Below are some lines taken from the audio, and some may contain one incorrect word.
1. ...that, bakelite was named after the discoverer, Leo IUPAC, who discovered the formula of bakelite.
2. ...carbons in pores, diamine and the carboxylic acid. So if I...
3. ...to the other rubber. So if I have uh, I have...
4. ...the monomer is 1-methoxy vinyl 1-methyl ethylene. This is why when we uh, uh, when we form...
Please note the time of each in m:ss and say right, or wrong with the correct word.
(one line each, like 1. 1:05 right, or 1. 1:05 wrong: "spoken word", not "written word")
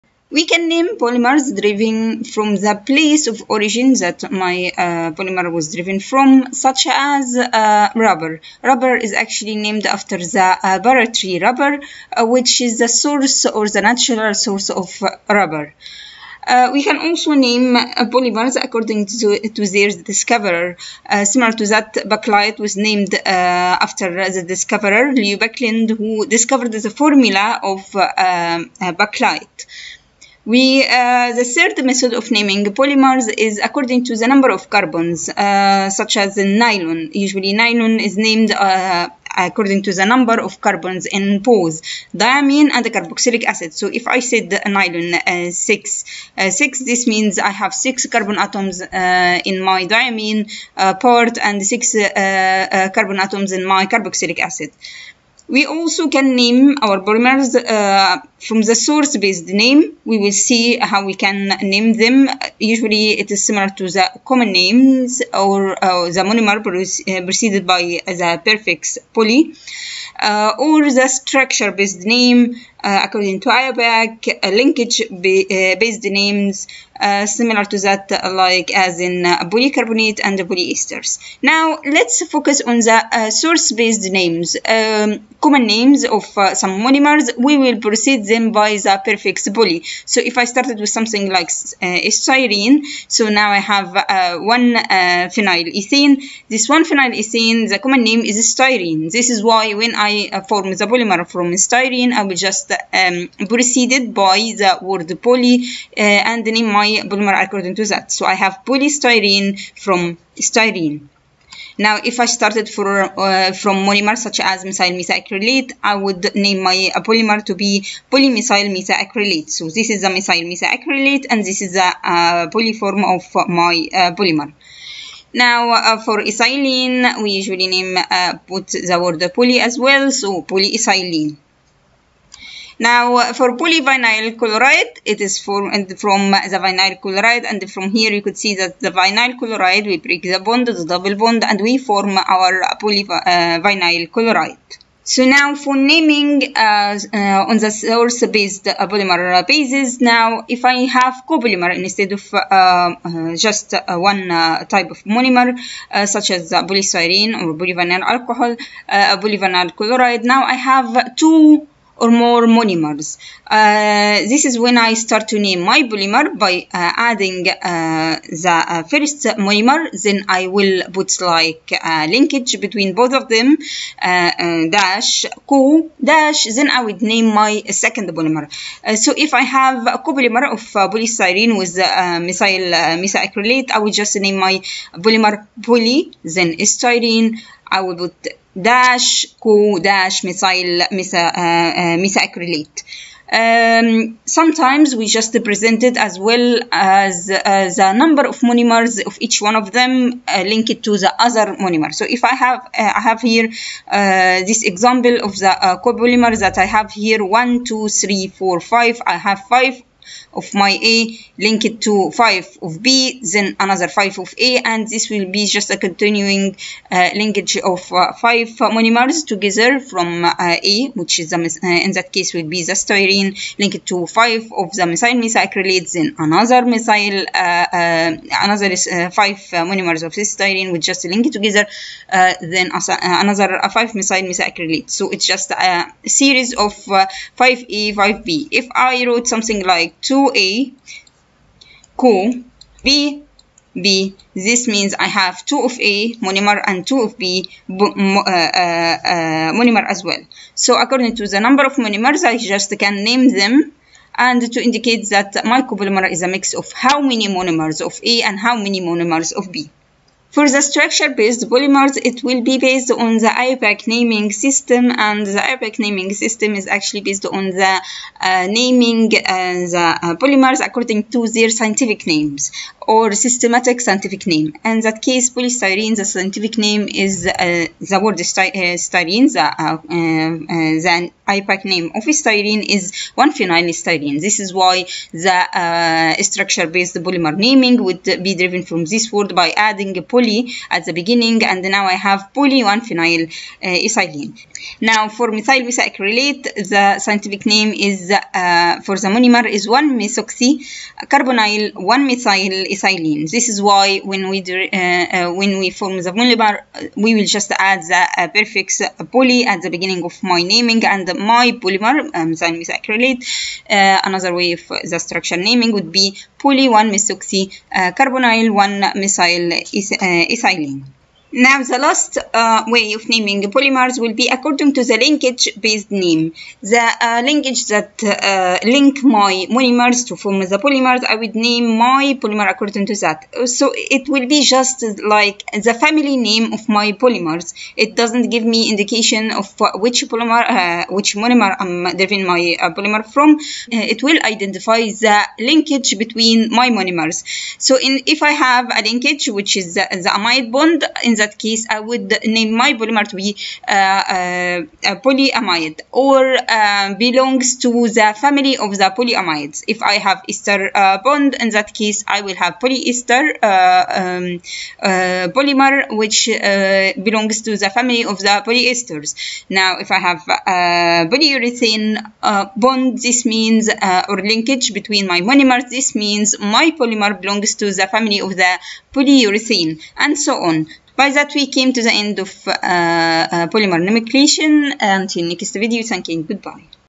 1. 0:21 wrong: "Baekeland", not "IUPAC"
2. 0:40 right
3. 3:20 wrong: "monomer", not "rubber"
4. 4:59 wrong: "carbonyl", not "vinyl".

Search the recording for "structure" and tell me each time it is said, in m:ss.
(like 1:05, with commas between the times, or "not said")
1:11, 4:20, 4:46, 5:15.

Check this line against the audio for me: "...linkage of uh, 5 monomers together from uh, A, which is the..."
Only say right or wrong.
right.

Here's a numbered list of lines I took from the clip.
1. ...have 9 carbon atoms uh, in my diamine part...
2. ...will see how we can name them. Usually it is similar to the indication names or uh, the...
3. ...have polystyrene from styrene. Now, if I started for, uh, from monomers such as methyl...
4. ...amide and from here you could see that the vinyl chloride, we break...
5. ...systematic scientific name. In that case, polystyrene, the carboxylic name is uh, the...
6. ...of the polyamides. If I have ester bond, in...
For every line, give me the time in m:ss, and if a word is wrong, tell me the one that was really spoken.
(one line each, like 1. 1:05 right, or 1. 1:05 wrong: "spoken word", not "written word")
1. 0:47 wrong: "6", not "9"
2. 1:00 wrong: "common", not "indication"
3. 1:48 right
4. 2:17 wrong: "chloride", not "amide"
5. 4:33 wrong: "scientific", not "carboxylic"
6. 5:58 right.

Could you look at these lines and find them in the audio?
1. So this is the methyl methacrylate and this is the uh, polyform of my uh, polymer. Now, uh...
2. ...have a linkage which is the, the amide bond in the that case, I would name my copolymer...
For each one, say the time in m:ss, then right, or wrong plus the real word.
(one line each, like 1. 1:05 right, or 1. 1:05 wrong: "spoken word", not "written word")
1. 1:59 right
2. 5:48 wrong: "polymer", not "copolymer".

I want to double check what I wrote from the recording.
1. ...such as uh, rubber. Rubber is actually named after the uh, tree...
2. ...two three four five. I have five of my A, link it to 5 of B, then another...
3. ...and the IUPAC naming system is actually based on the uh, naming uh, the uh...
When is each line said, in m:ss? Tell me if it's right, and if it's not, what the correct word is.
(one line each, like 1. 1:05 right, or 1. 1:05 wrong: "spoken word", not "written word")
1. 0:06 right
2. 3:27 right
3. 4:24 right.